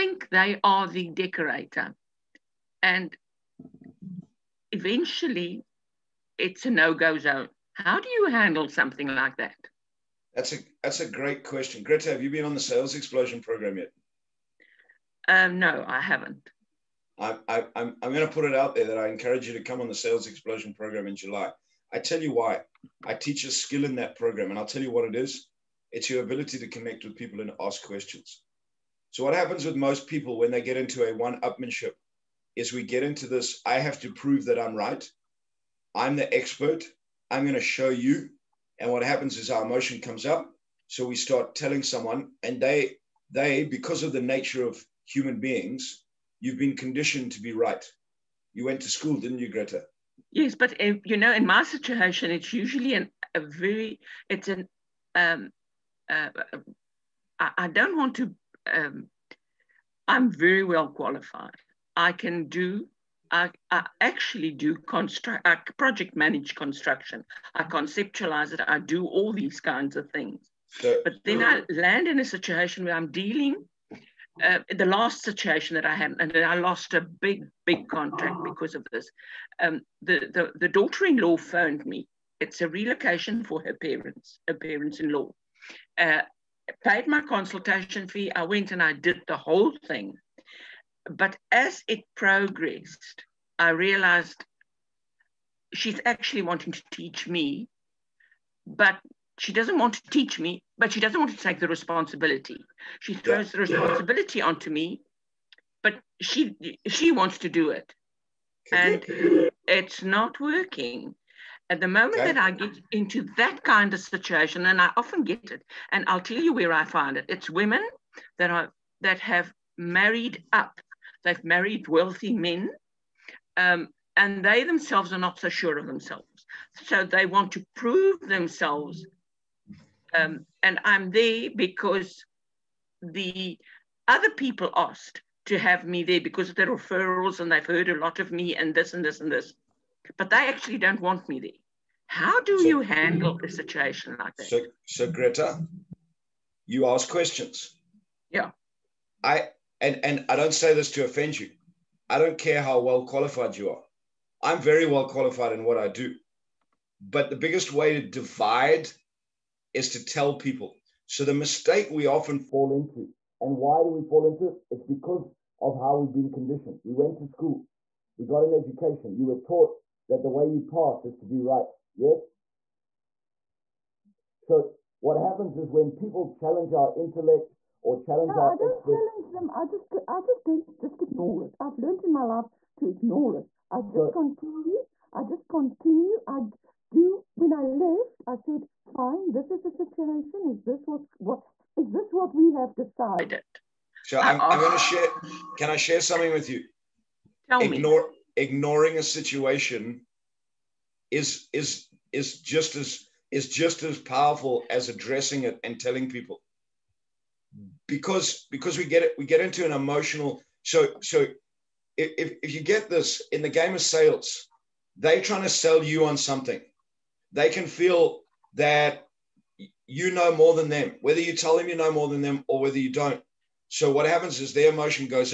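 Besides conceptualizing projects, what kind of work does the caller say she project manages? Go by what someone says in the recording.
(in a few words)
Construction.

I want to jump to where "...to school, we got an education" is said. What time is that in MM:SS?
02:47.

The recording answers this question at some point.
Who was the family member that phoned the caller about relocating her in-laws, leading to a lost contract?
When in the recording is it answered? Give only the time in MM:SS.
01:20.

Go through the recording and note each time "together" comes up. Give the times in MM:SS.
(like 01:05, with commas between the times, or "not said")
not said.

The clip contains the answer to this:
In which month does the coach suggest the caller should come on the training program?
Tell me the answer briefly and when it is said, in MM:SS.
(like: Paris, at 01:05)
July, at 00:21.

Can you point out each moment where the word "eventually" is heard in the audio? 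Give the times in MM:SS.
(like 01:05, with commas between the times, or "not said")
00:04.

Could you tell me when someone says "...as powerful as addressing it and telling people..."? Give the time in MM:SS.
03:23.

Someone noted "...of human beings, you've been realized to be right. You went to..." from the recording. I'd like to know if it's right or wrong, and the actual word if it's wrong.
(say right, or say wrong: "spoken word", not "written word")
wrong: "conditioned", not "realized".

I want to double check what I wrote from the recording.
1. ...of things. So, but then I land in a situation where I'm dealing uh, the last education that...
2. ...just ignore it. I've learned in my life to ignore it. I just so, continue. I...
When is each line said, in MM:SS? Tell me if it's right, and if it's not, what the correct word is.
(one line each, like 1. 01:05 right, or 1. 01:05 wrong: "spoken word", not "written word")
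1. 01:09 wrong: "situation", not "education"
2. 03:00 right.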